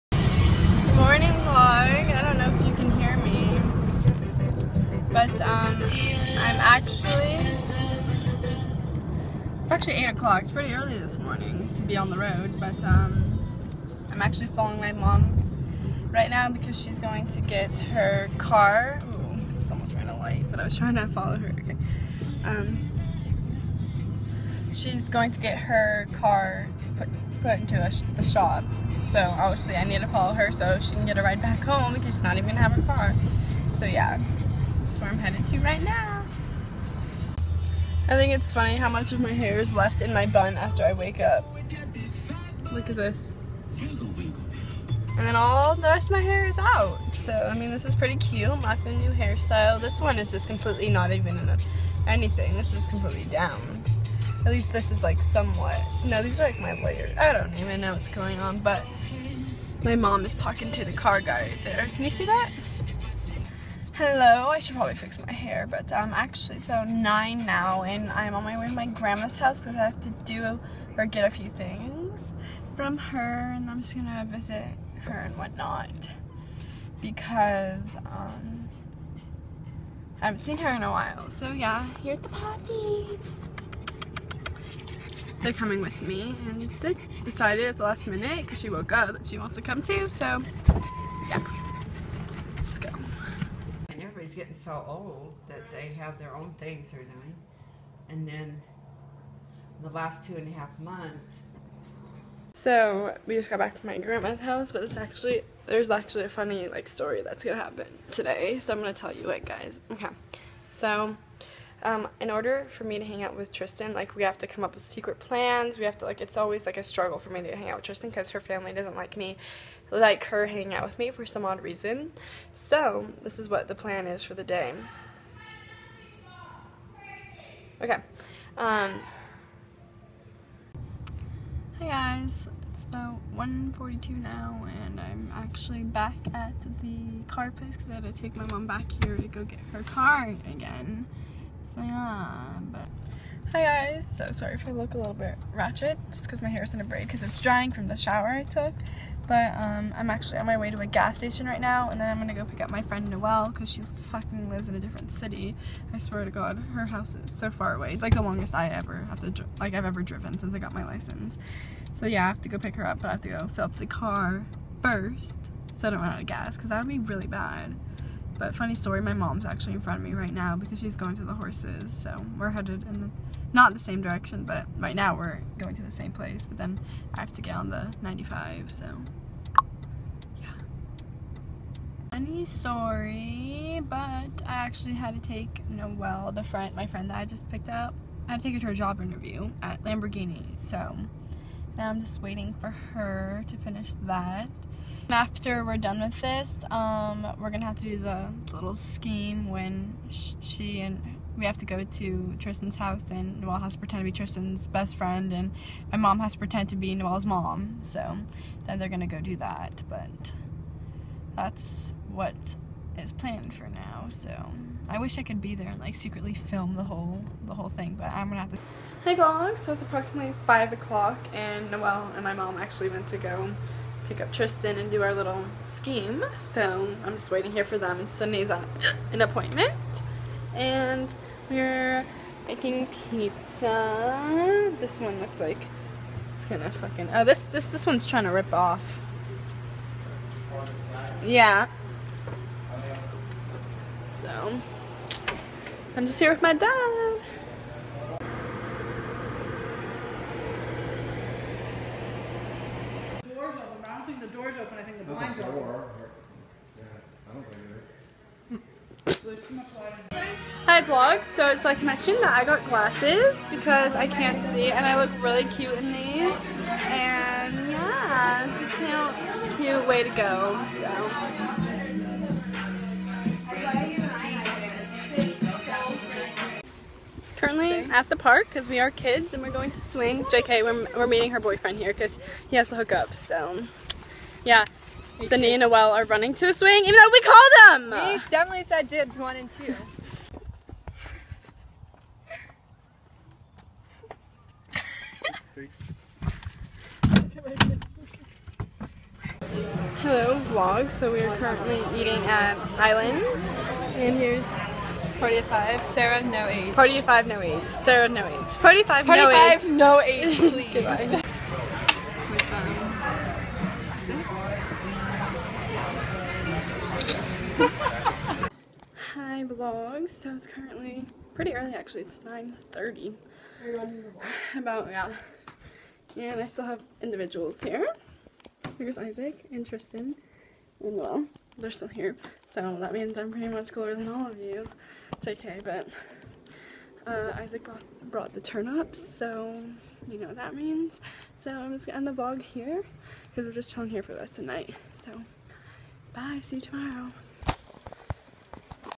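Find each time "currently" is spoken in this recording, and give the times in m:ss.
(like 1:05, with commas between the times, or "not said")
4:37, 5:01, 5:20.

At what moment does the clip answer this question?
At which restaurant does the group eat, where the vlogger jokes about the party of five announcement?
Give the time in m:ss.
5:02.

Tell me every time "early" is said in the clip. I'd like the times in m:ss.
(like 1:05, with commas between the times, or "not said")
0:10, 5:21.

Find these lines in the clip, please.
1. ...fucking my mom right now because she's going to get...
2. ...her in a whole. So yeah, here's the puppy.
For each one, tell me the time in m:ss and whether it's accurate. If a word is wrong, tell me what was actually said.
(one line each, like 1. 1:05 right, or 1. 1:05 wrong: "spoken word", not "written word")
1. 0:14 wrong: "following", not "fucking"
2. 1:20 wrong: "while", not "whole".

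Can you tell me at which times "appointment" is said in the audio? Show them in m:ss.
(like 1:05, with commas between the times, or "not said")
3:49.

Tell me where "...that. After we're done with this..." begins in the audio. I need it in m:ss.
3:14.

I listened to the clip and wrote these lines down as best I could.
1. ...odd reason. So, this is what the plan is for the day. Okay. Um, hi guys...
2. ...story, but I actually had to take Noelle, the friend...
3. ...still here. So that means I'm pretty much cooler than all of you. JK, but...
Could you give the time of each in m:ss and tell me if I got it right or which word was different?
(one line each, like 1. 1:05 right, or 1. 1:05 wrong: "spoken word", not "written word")
1. 2:01 right
2. 3:02 right
3. 5:31 right.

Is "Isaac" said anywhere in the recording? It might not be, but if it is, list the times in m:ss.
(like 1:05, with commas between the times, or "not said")
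5:28, 5:37.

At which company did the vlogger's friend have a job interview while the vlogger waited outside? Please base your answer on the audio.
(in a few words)
Lamborghini.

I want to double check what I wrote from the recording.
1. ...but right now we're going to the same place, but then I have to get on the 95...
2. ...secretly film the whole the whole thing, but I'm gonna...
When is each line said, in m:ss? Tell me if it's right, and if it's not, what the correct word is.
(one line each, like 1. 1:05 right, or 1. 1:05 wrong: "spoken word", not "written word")
1. 2:54 right
2. 3:35 right.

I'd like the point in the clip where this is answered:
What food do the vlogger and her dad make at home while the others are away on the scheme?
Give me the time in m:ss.
3:52.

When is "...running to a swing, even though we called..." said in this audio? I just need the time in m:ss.
4:46.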